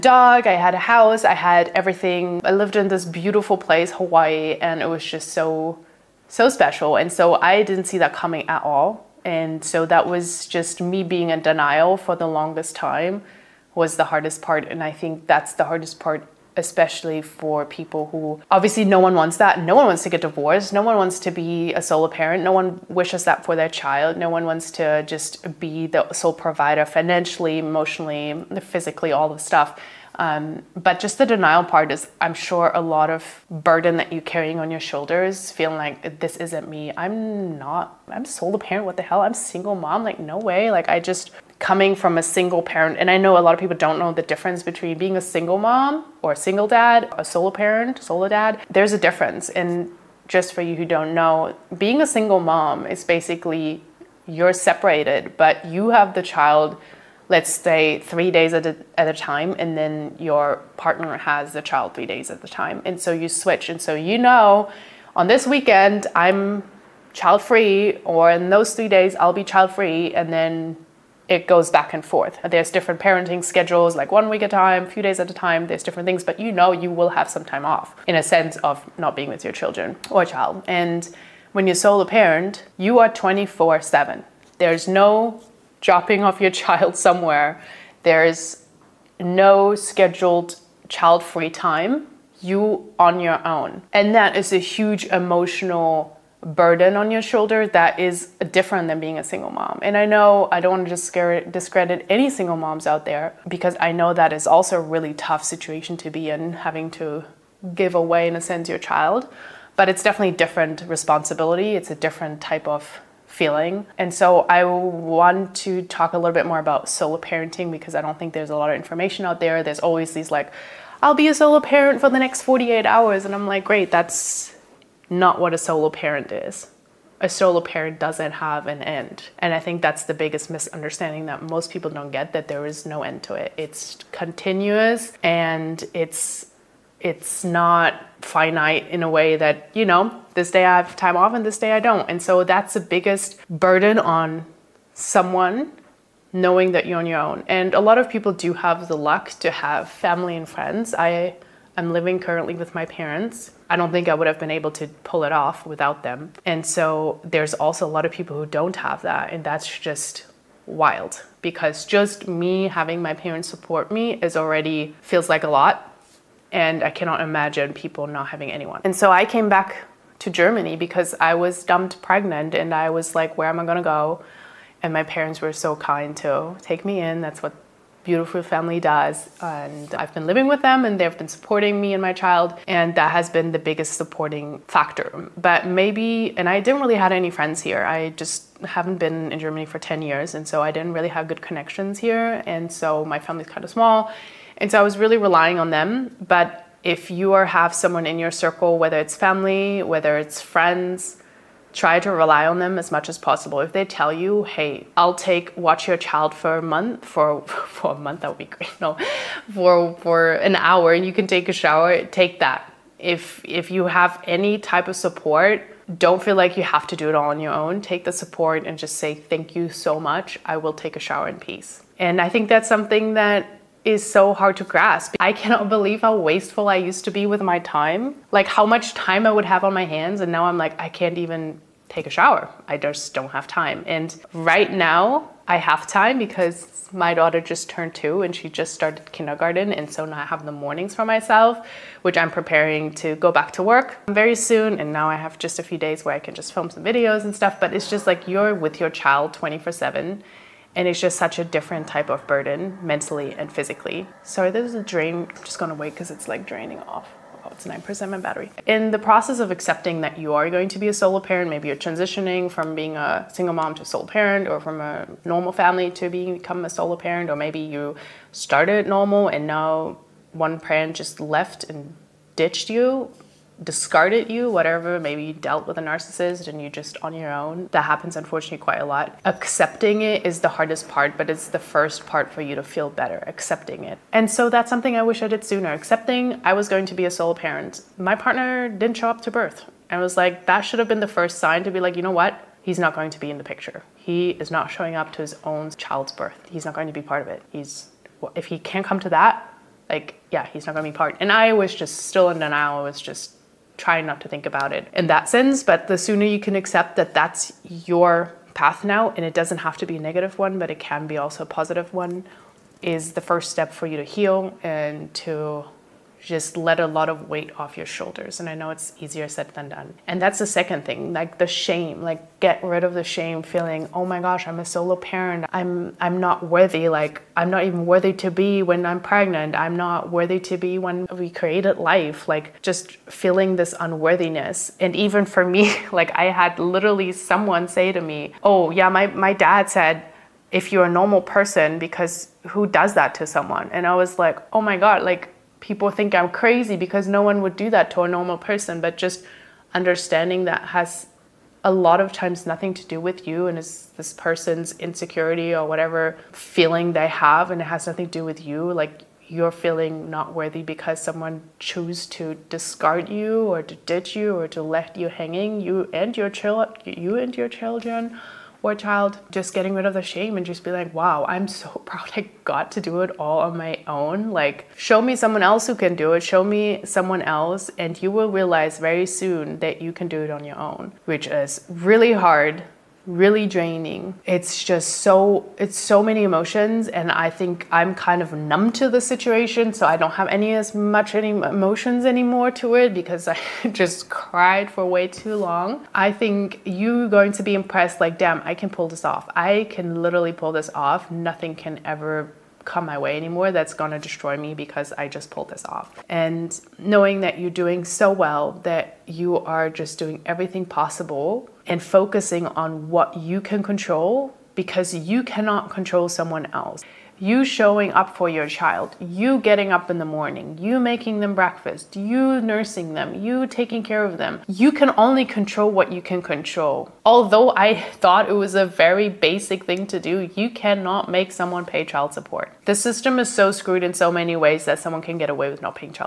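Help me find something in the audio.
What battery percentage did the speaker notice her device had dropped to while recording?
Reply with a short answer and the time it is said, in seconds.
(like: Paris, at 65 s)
9%, at 257 s.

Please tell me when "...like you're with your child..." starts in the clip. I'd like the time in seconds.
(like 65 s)
248 s.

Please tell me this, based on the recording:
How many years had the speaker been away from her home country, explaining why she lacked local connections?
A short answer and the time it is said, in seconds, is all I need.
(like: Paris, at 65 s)
10 years, at 189 s.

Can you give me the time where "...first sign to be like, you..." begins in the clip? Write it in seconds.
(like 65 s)
291 s.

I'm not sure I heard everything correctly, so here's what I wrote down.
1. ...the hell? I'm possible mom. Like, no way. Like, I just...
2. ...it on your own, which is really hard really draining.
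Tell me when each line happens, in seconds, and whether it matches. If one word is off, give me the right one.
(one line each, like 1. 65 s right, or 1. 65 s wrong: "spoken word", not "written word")
1. 38 s wrong: "single", not "possible"
2. 380 s right.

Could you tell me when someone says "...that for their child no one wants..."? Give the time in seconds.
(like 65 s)
23 s.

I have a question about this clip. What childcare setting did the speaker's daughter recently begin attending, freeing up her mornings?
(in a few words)
Kindergarten.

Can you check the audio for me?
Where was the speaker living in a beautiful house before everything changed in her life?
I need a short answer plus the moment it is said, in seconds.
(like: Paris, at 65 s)
Hawaii, at 3 s.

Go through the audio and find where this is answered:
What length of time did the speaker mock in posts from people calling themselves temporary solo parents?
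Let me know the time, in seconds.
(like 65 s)
122 s.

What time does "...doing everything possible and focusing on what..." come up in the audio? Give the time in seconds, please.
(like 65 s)
409 s.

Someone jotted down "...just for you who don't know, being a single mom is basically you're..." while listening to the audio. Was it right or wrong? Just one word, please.
right.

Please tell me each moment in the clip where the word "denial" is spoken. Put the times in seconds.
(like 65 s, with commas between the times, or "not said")
11 s, 31 s, 302 s.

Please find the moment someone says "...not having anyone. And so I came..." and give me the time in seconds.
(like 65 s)
168 s.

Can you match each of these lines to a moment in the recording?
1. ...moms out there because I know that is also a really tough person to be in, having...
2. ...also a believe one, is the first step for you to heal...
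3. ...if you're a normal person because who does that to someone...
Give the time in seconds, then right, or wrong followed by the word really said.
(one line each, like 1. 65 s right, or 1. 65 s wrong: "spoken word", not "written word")
1. 102 s wrong: "situation", not "person"
2. 311 s wrong: "positive", not "believe"
3. 340 s right.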